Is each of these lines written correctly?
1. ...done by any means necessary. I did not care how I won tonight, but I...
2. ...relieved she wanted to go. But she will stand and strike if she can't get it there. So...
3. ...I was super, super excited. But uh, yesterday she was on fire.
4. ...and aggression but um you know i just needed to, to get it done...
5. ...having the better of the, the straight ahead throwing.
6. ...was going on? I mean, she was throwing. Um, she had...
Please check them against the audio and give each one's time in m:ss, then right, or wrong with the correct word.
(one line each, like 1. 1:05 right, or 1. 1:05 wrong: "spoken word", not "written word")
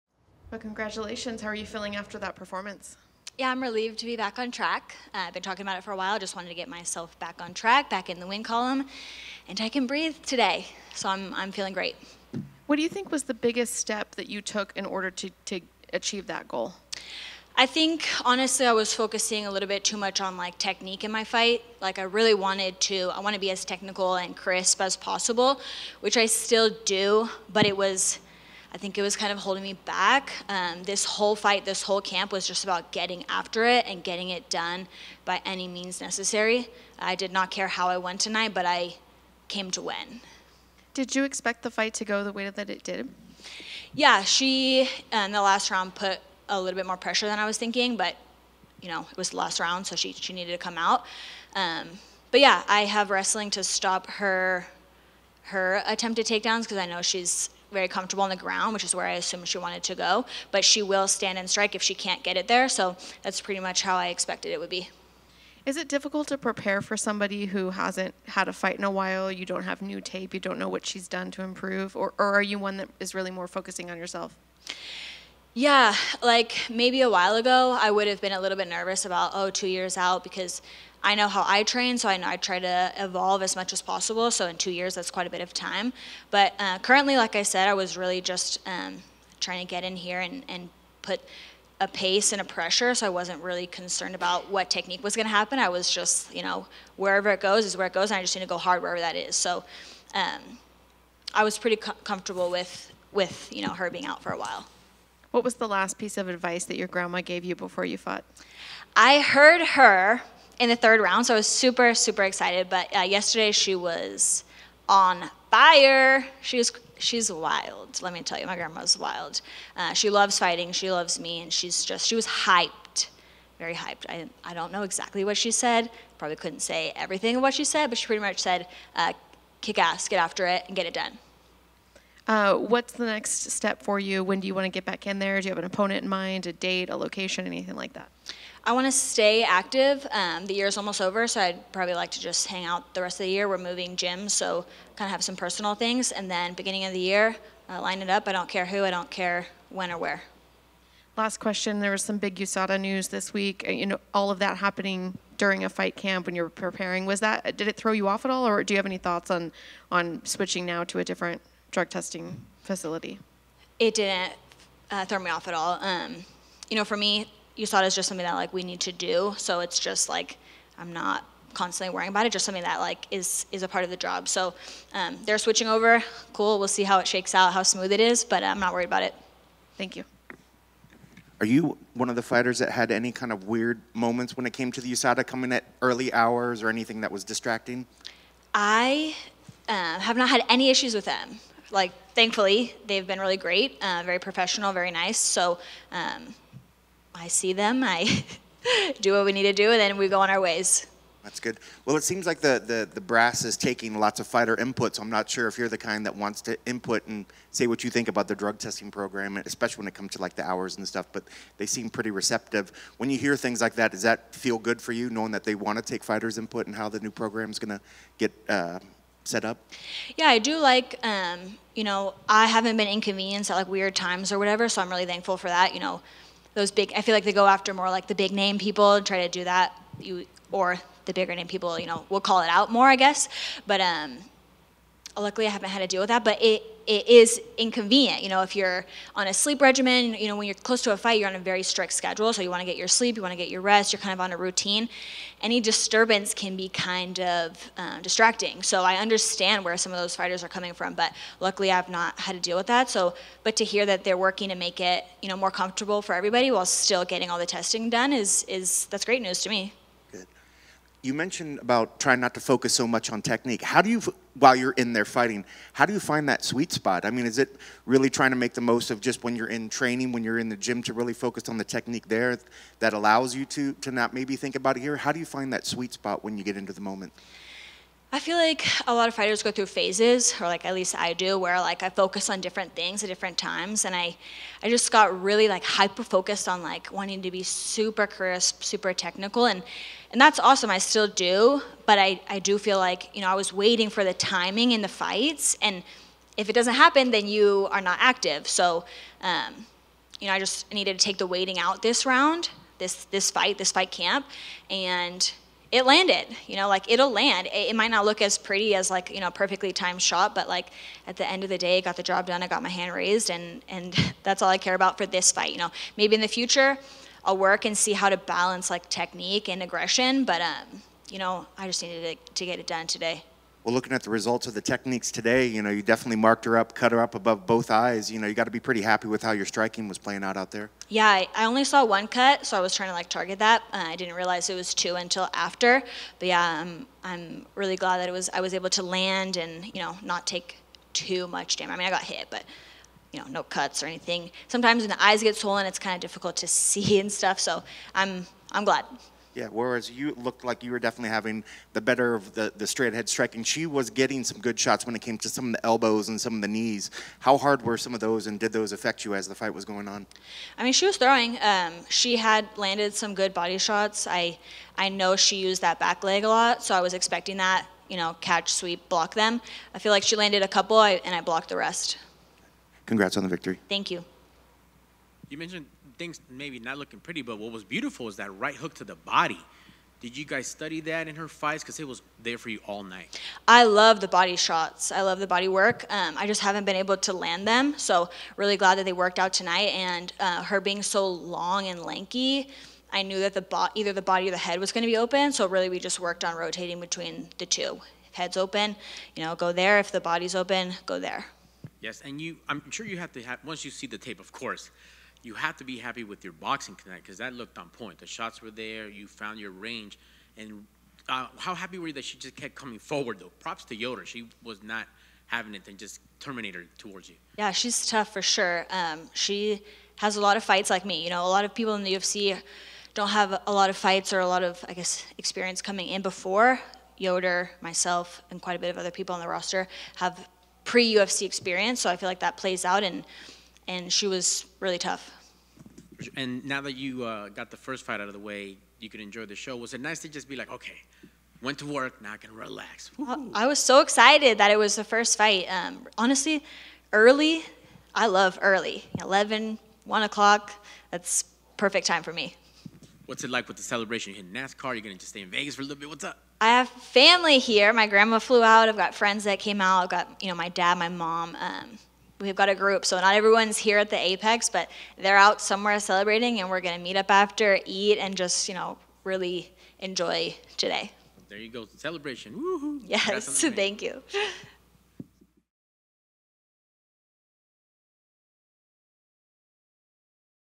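1. 0:34 right
2. 0:59 wrong: "assumed", not "relieved"
3. 1:51 right
4. 5:19 right
5. 5:51 wrong: "striking", not "throwing"
6. 5:59 right.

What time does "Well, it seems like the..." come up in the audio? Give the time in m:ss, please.
3:21.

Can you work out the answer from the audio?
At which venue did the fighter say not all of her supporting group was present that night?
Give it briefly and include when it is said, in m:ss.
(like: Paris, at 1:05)
the Apex, at 7:43.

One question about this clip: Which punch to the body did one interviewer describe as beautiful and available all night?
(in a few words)
right hook.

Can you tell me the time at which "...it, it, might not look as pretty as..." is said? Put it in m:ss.
5:07.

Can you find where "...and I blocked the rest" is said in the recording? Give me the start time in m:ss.
6:10.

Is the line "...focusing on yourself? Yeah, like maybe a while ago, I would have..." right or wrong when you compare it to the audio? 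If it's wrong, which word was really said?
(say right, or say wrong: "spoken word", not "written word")
right.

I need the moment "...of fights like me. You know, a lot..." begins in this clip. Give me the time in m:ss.
7:00.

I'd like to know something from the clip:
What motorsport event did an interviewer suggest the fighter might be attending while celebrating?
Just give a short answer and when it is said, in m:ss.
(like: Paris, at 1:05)
NASCAR, at 7:34.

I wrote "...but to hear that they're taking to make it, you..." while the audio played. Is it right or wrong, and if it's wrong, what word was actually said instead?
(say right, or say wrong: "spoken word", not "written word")
wrong: "working", not "taking".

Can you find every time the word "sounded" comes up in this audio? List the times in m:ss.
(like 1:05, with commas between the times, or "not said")
not said.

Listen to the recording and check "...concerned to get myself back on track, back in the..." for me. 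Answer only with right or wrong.
wrong.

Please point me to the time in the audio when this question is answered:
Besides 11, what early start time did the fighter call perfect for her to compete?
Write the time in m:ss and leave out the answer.
7:29.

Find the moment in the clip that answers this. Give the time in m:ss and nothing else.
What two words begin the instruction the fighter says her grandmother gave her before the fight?
2:09.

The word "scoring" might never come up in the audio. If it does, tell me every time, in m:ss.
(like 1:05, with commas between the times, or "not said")
not said.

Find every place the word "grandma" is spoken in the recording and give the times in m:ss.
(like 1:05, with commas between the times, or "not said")
1:46, 1:58, 7:37.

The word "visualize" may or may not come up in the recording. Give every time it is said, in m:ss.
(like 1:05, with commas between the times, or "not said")
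not said.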